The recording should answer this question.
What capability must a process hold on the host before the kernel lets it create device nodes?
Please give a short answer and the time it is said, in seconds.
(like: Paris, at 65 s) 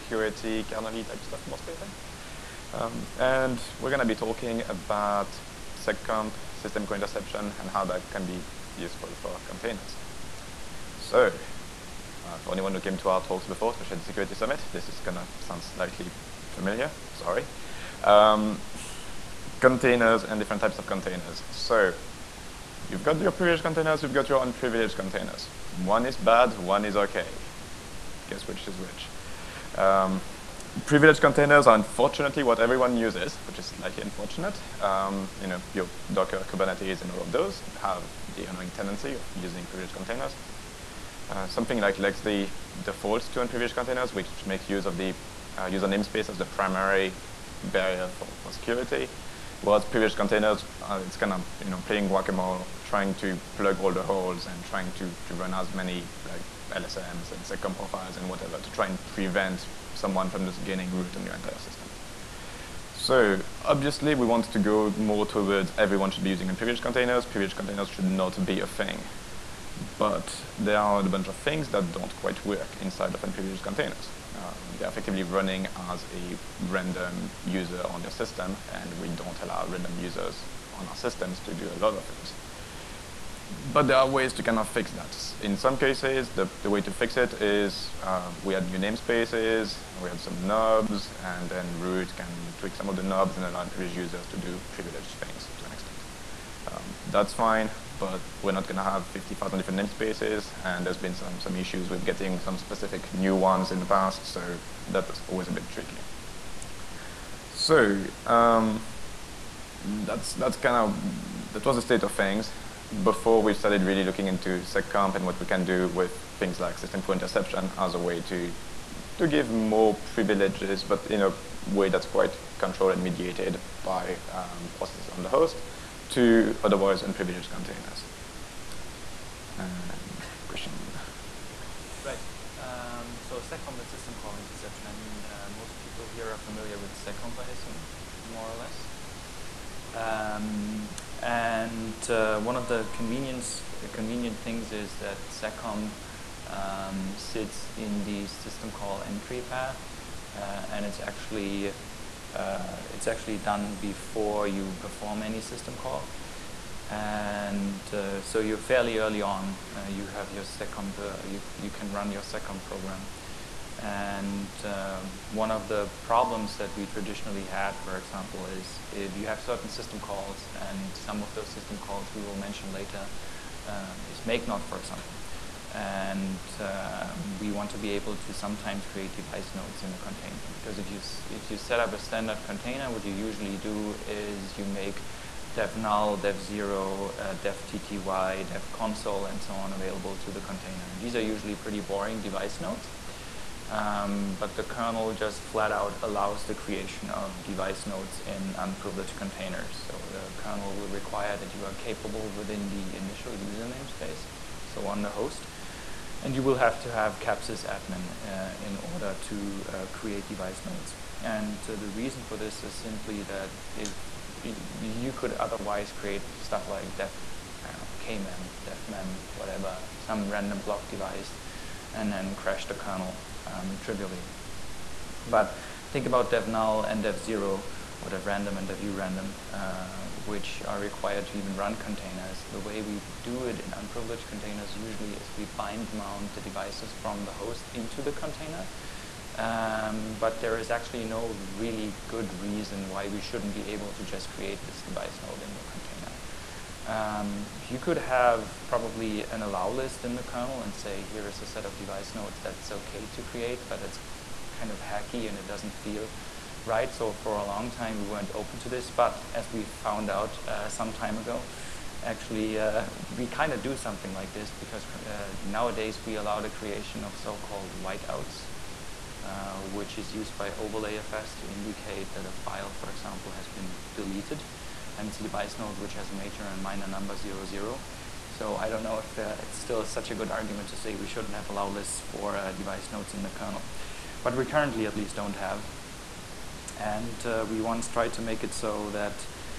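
CAP_SYS_ADMIN, at 207 s.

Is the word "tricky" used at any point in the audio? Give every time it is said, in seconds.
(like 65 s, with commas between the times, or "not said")
105 s.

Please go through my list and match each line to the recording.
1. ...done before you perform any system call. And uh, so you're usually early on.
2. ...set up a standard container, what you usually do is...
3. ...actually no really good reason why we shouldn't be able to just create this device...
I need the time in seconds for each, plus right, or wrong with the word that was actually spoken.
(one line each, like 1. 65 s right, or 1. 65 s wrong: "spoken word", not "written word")
1. 153 s wrong: "fairly", not "usually"
2. 181 s right
3. 240 s right.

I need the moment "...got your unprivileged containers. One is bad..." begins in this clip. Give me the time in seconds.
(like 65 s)
24 s.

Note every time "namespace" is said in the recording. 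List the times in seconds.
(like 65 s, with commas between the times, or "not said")
45 s, 88 s, 99 s, 203 s.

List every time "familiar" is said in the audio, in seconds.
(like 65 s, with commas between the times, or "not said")
16 s, 136 s.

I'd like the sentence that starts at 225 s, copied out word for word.
But think about dev null and dev zero or dev random and dev random, uh, which are required to even run containers.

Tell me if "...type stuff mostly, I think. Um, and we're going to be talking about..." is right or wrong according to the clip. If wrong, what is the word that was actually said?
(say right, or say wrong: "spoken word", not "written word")
right.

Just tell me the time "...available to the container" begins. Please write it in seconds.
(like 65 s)
189 s.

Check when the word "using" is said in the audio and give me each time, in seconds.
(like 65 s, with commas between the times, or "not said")
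39 s, 66 s.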